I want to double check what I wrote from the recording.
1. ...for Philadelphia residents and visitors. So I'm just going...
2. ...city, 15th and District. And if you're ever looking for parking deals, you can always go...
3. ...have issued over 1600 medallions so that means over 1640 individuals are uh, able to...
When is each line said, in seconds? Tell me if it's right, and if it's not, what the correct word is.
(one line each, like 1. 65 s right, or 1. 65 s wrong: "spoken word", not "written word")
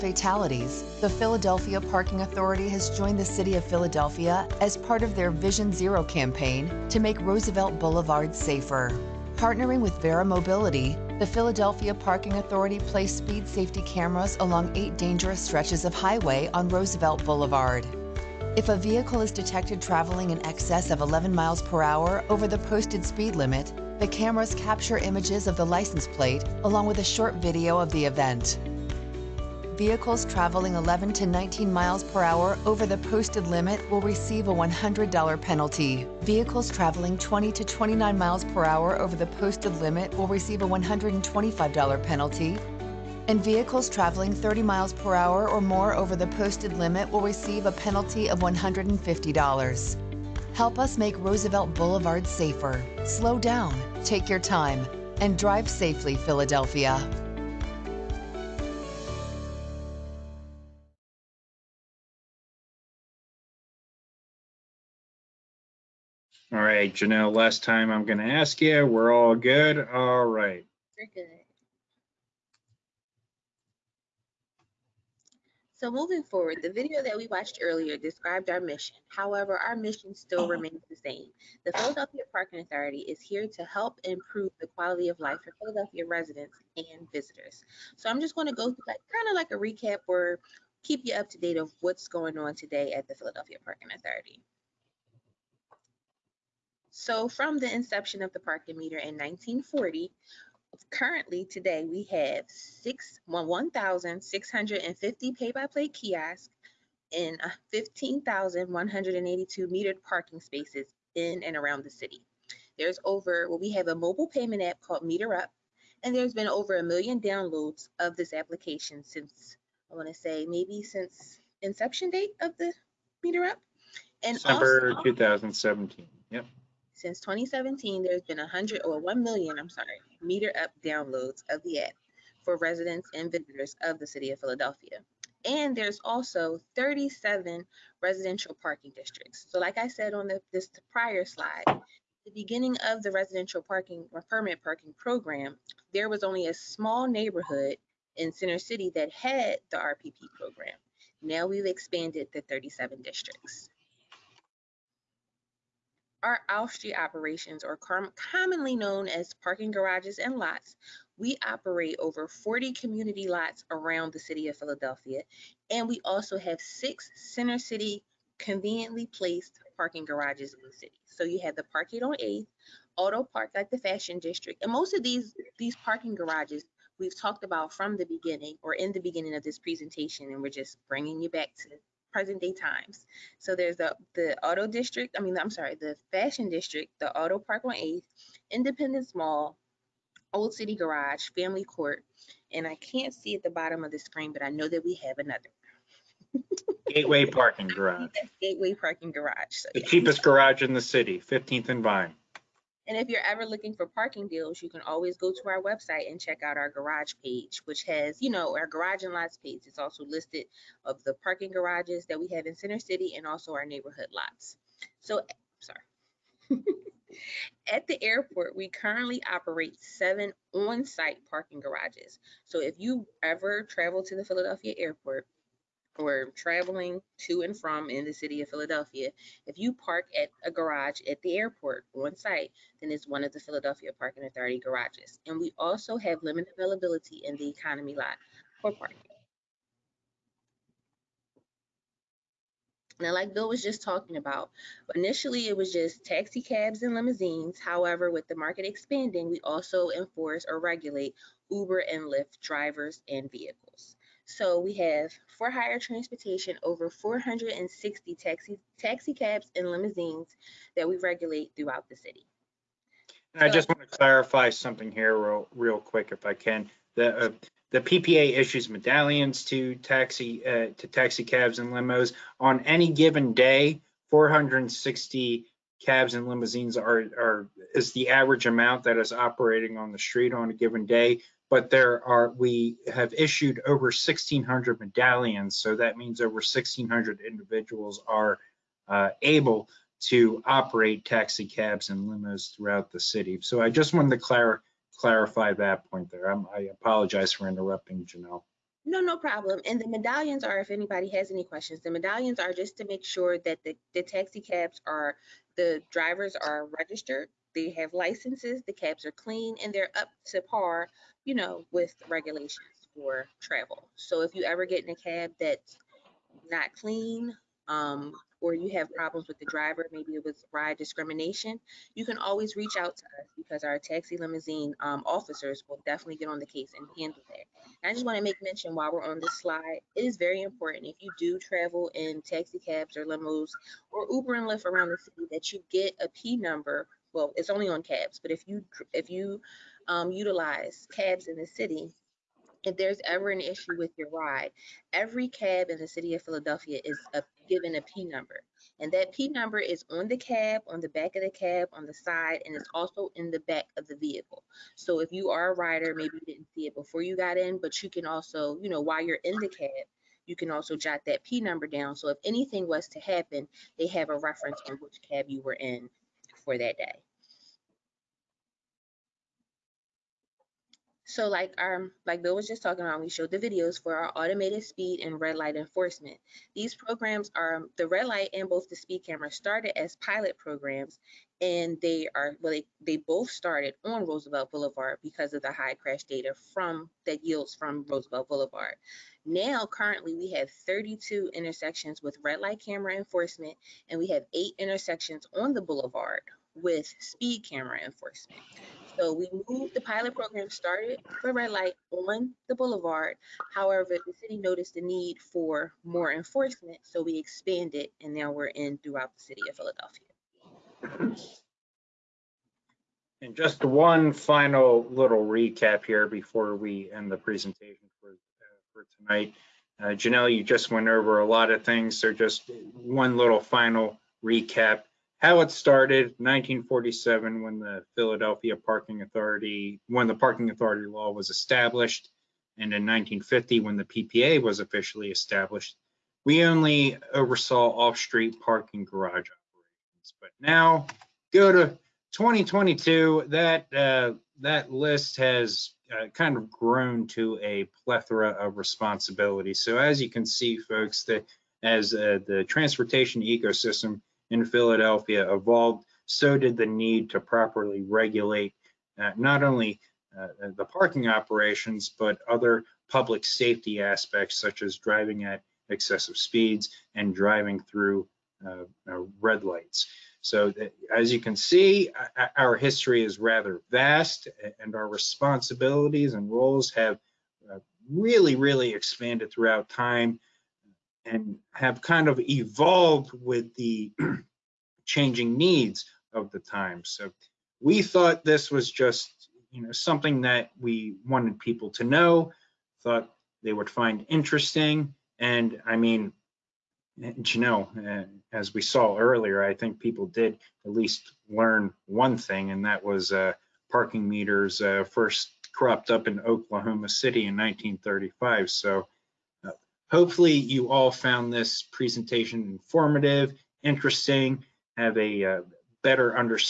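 1. 85 s right
2. 200 s wrong: "Vine", not "District"
3. 282 s wrong: "1600", not "1640".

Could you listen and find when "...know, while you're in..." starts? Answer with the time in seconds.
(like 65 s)
358 s.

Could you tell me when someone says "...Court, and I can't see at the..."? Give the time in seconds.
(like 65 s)
191 s.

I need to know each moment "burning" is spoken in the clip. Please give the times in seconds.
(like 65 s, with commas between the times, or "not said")
not said.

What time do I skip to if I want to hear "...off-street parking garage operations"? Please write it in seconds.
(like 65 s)
437 s.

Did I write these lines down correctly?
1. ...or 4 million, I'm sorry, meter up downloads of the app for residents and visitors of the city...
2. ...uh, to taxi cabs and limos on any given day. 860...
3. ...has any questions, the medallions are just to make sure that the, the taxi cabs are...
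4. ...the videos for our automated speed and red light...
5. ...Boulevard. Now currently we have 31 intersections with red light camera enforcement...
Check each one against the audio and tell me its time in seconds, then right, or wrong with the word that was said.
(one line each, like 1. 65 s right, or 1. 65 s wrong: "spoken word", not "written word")
1. 128 s wrong: "1", not "4"
2. 270 s wrong: "460", not "860"
3. 301 s right
4. 373 s right
5. 388 s wrong: "32", not "31".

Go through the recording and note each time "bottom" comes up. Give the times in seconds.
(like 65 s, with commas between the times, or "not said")
193 s.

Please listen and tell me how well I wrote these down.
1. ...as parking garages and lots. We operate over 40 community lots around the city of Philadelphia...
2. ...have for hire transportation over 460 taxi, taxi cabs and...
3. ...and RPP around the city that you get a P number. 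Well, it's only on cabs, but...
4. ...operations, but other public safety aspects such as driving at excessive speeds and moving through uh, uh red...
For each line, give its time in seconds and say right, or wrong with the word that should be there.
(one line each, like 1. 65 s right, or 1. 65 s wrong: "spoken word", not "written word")
1. 159 s right
2. 254 s right
3. 334 s wrong: "Lyft", not "RPP"
4. 461 s wrong: "driving", not "moving".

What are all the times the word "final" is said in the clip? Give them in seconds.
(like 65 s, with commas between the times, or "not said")
414 s, 423 s.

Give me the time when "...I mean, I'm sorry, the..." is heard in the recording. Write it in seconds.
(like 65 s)
185 s.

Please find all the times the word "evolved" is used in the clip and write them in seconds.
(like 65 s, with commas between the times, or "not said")
455 s, 482 s.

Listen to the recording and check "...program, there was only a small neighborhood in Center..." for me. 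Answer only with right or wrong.
right.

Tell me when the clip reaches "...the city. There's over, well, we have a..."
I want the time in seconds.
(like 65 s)
111 s.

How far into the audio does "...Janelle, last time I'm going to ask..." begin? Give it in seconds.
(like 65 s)
66 s.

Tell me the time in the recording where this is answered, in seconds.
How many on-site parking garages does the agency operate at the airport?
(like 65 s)
219 s.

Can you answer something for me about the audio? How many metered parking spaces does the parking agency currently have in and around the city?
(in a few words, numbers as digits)
15,182.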